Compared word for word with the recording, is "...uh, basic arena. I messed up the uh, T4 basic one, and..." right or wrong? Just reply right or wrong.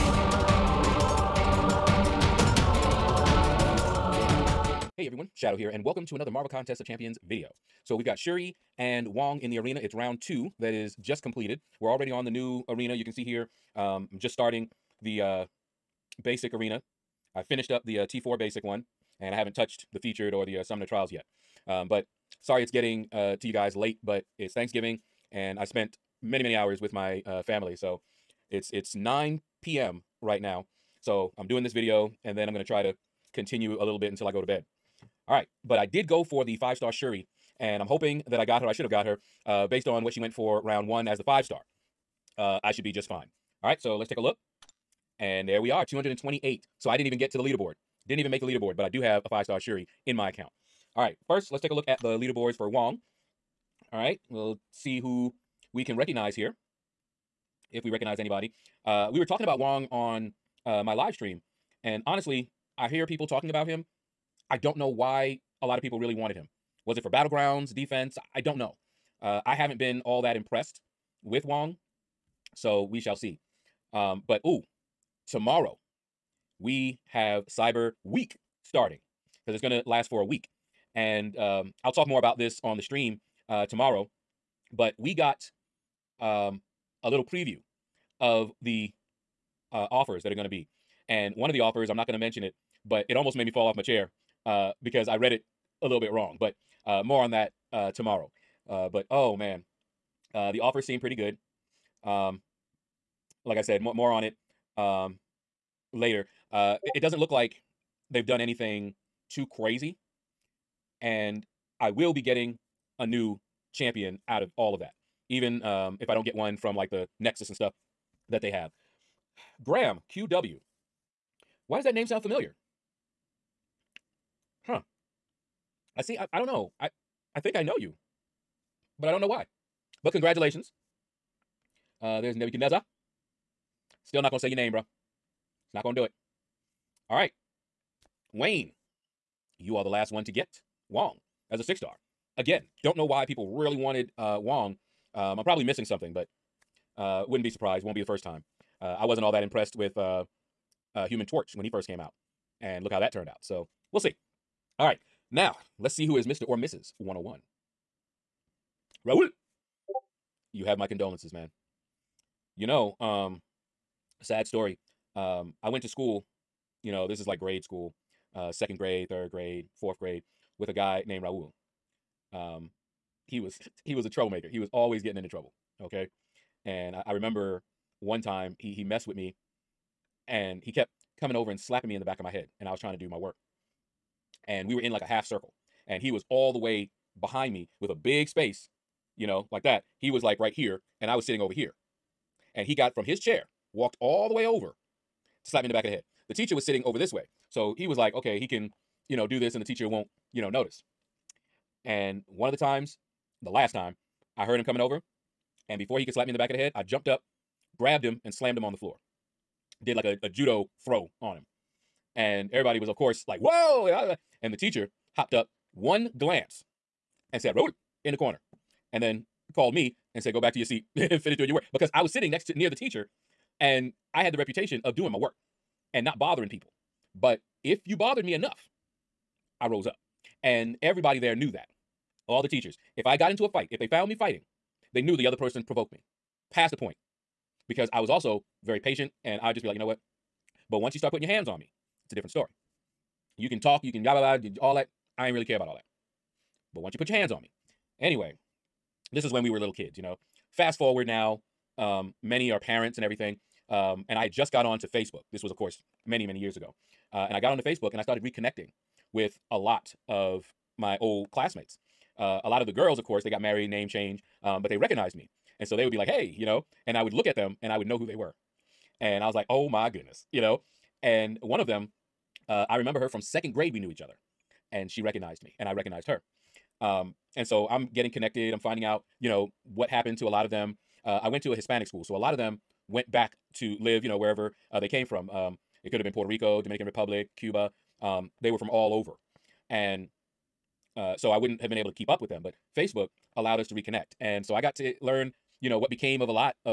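wrong.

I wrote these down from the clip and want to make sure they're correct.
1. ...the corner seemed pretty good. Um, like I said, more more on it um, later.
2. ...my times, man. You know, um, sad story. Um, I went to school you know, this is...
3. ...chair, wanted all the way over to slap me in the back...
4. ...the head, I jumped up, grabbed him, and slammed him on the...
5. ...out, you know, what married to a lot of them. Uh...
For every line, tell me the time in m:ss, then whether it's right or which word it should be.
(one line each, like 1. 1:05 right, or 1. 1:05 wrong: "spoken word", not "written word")
1. 1:40 wrong: "offer", not "corner"
2. 2:40 wrong: "condolences", not "times"
3. 3:13 wrong: "walked", not "wanted"
4. 3:26 right
5. 4:38 wrong: "happened", not "married".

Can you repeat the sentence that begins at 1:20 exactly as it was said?
And um, I'll talk more about this on the stream uh, tomorrow.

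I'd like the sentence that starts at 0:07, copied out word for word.
So we've got Shuri and Wong in the arena.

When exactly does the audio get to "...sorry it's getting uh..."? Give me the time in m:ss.
0:22.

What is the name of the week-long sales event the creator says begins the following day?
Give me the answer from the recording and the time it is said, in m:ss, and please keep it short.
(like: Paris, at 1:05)
Cyber Week, at 1:17.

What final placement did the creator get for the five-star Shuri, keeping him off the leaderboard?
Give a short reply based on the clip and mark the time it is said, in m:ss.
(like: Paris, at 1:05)
228, at 0:45.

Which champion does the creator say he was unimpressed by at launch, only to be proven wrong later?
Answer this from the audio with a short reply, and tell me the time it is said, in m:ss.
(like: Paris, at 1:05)
Human Torch, at 2:31.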